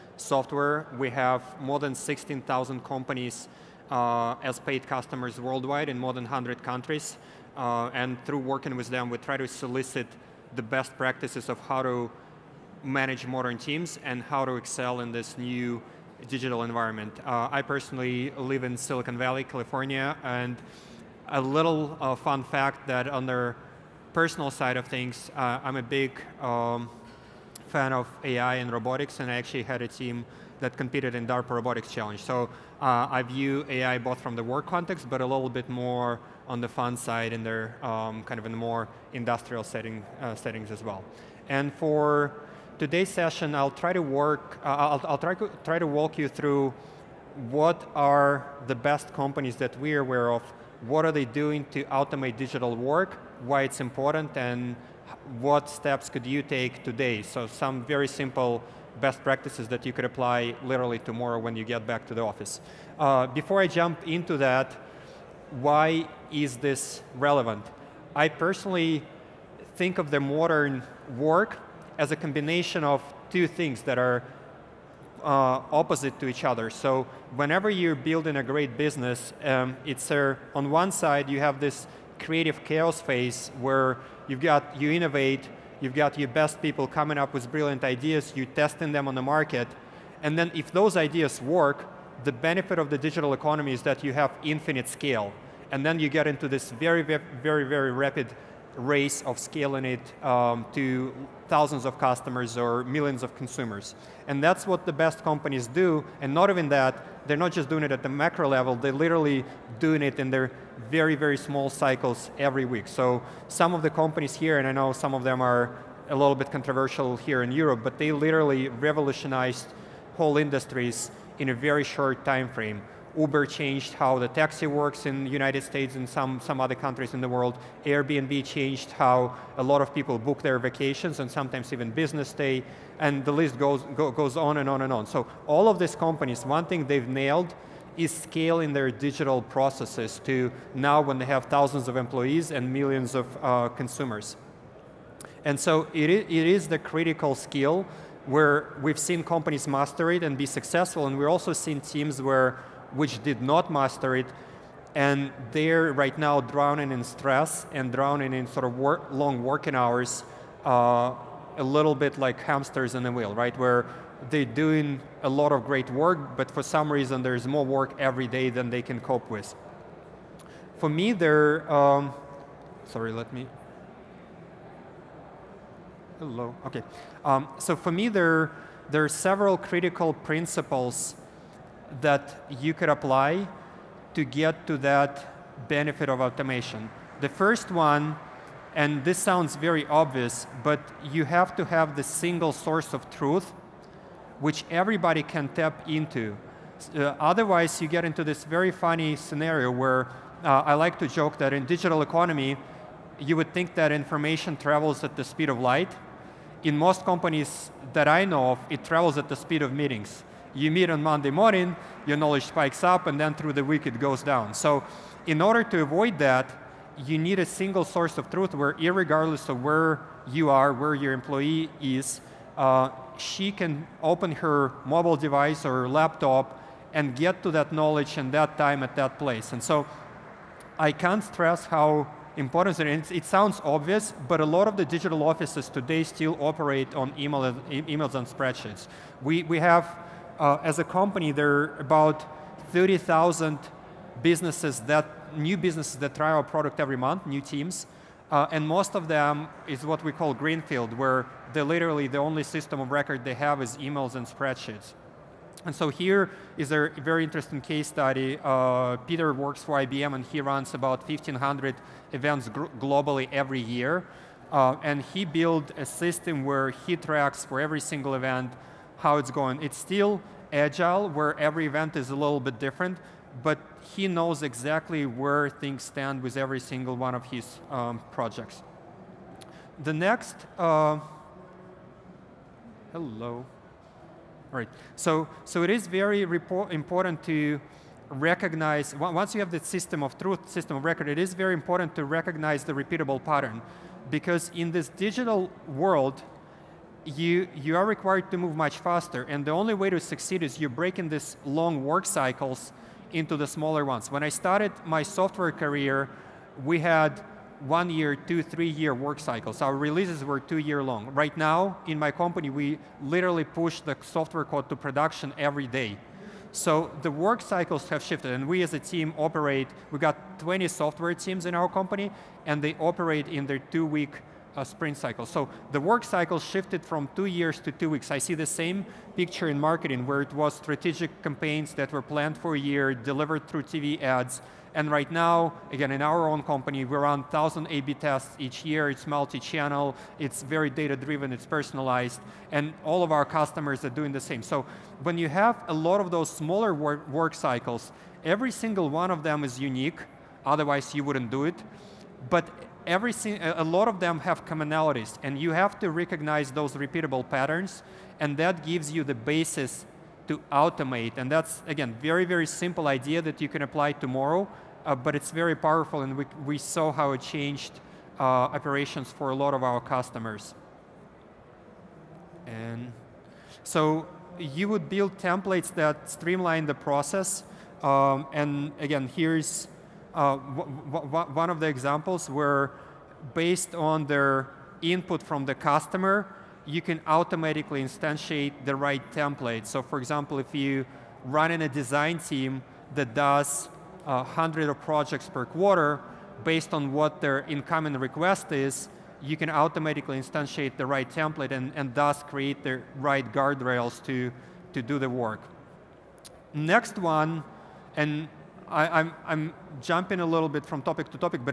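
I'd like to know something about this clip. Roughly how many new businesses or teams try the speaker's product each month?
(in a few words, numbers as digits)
30,000.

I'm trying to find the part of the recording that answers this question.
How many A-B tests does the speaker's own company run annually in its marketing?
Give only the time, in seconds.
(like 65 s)
337 s.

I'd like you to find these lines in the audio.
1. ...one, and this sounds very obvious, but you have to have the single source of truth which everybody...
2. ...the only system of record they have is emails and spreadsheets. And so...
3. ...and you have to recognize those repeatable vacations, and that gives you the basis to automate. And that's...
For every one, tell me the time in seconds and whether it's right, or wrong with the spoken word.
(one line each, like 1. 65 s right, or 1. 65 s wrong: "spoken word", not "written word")
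1. 187 s right
2. 252 s right
3. 355 s wrong: "patterns", not "vacations".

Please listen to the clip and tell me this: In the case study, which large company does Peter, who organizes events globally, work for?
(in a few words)
IBM.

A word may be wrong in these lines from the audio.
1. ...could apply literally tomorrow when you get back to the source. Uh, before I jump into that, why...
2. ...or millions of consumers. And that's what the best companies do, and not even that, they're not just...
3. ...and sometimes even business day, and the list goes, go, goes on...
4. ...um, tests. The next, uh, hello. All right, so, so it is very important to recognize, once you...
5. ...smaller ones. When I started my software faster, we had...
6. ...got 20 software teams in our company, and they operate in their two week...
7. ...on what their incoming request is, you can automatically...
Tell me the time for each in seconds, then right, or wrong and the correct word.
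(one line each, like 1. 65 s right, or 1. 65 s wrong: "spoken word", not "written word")
1. 59 s wrong: "office", not "source"
2. 102 s right
3. 131 s right
4. 277 s wrong: "projects", not "tests"
5. 303 s wrong: "career", not "faster"
6. 319 s right
7. 396 s right.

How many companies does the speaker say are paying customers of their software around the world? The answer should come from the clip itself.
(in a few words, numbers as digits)
16,000.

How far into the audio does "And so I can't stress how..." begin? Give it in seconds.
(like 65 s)
229 s.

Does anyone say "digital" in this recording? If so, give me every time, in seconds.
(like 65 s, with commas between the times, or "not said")
16 s, 52 s, 92 s, 138 s, 201 s, 234 s, 294 s.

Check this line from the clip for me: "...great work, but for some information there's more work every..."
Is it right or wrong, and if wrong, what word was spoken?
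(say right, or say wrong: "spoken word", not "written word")
wrong: "reason", not "information".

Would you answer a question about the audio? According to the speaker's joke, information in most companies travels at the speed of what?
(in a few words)
meetings.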